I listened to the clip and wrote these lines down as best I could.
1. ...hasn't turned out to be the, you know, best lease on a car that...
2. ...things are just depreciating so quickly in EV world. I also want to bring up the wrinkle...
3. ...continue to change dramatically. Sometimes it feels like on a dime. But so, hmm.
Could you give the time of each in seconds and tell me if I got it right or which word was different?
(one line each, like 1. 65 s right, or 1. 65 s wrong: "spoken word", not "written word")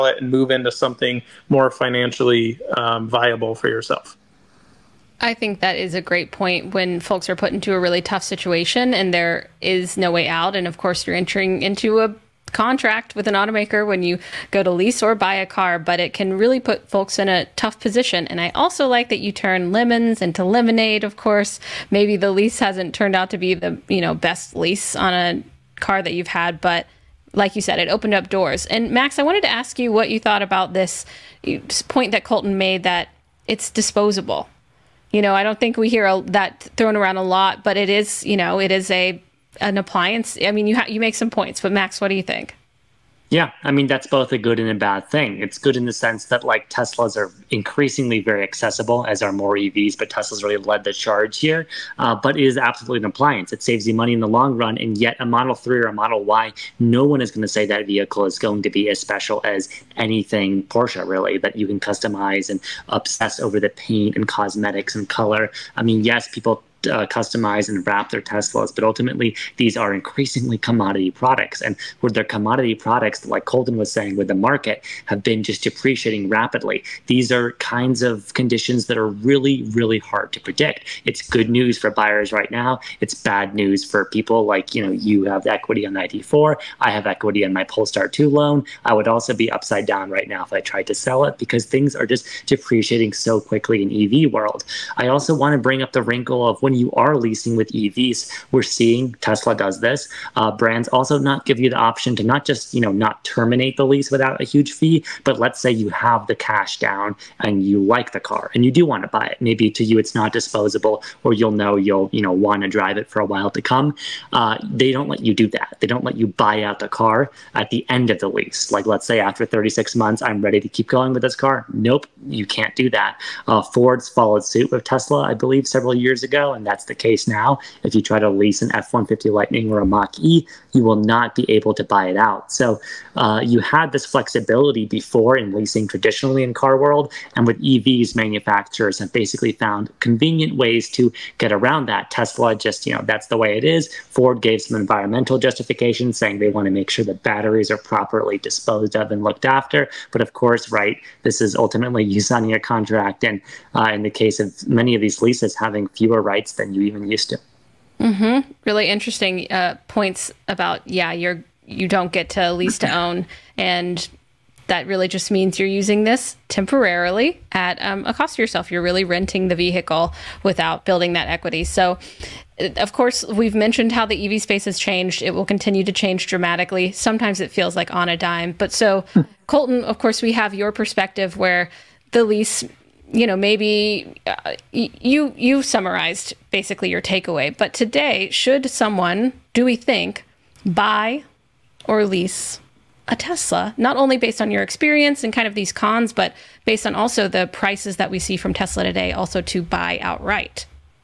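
1. 22 s right
2. 91 s right
3. 175 s right.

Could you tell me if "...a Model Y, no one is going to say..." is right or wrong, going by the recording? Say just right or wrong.
right.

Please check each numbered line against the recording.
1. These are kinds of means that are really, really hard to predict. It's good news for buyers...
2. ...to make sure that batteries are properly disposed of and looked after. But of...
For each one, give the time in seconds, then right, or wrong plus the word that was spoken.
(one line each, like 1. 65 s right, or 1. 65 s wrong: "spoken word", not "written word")
1. 77 s wrong: "conditions", not "means"
2. 146 s right.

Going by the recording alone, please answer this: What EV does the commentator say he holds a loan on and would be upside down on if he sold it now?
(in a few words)
Polestar 2.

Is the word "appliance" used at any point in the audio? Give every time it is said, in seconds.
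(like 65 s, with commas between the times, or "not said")
39 s, 53 s.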